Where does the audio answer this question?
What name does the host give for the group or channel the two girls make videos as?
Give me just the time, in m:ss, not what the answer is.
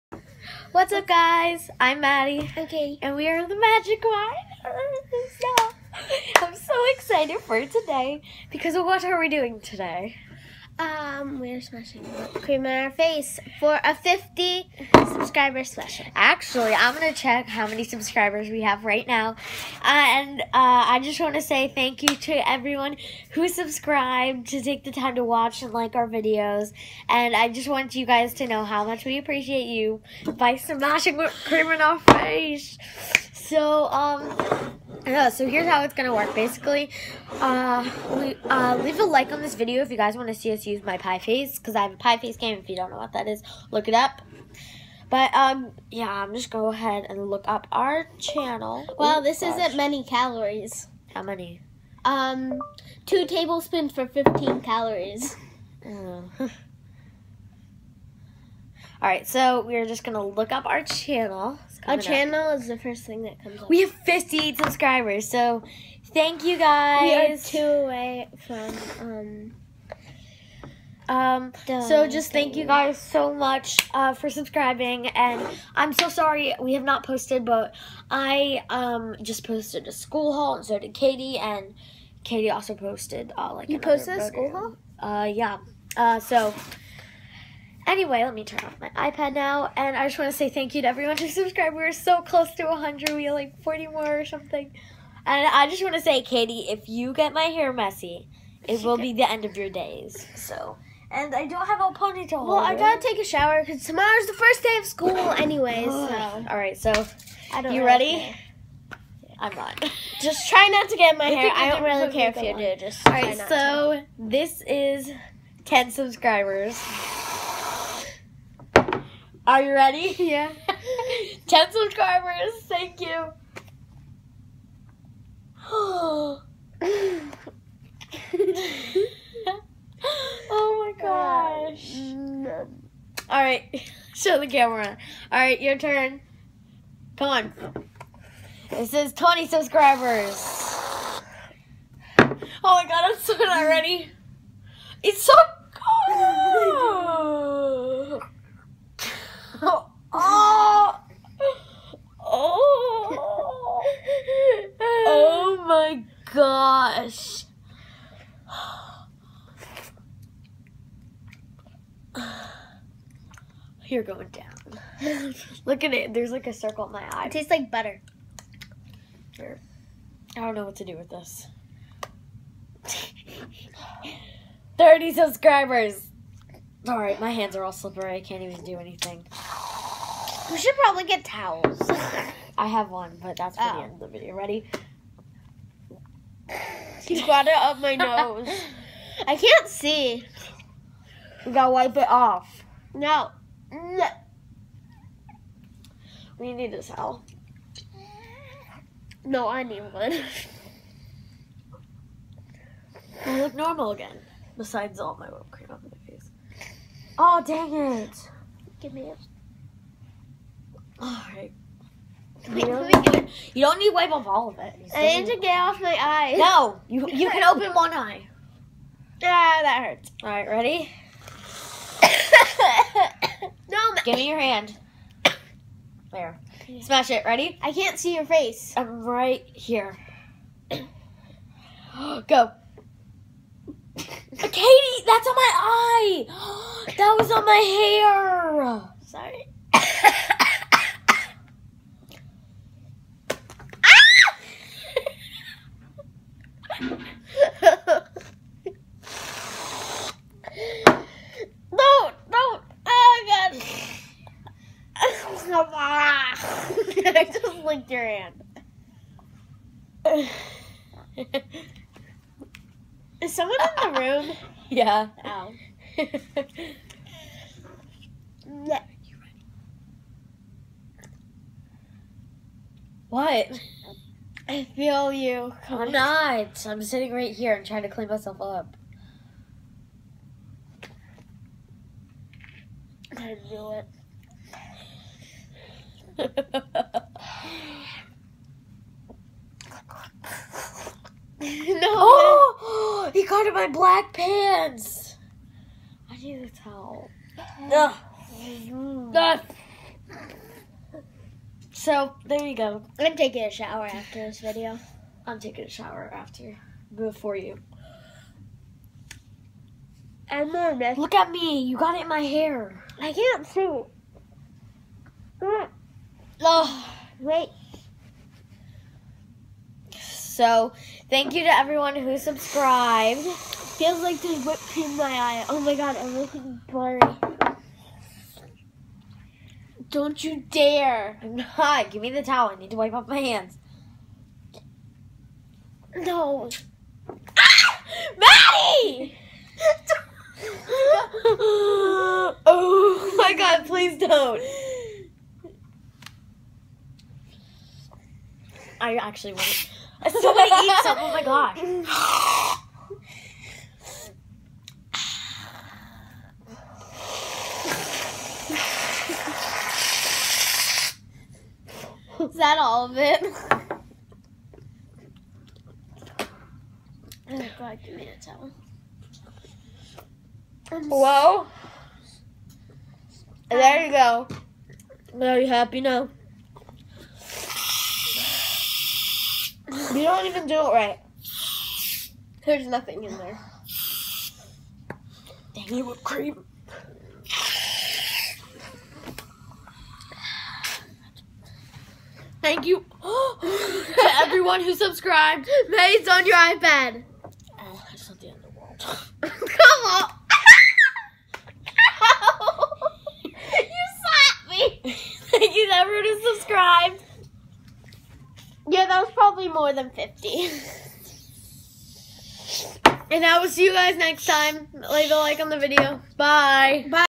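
0:03.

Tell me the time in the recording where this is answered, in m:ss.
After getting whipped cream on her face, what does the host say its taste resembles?
2:47.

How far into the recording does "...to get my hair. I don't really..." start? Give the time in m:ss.
1:50.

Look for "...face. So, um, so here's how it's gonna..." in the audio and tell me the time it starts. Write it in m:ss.
0:31.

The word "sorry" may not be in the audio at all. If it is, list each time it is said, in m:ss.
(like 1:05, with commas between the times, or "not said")
1:16, 3:59.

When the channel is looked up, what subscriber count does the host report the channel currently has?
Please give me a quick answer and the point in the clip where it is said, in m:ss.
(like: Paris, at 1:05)
58, at 1:03.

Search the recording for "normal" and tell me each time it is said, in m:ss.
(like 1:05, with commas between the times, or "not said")
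3:23.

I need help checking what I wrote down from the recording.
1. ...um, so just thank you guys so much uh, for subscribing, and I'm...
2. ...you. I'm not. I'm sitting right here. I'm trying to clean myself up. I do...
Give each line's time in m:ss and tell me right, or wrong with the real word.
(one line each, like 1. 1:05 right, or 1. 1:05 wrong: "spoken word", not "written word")
1. 1:11 right
2. 4:35 right.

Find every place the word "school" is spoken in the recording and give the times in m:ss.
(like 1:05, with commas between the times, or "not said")
1:19, 1:24, 1:44.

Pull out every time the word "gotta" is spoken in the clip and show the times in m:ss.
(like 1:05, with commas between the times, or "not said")
1:42, 3:11.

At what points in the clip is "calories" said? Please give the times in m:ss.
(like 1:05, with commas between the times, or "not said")
0:50, 0:54.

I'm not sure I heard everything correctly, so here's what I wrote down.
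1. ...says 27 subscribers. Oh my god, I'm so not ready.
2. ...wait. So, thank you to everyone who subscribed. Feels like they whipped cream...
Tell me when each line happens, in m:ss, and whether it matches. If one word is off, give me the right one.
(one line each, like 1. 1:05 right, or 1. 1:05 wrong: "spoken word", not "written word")
1. 2:18 wrong: "20", not "27"
2. 5:17 right.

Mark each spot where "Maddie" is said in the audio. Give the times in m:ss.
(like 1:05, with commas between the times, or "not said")
0:01, 5:38.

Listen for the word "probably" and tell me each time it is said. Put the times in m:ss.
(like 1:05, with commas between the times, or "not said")
3:00, 6:49.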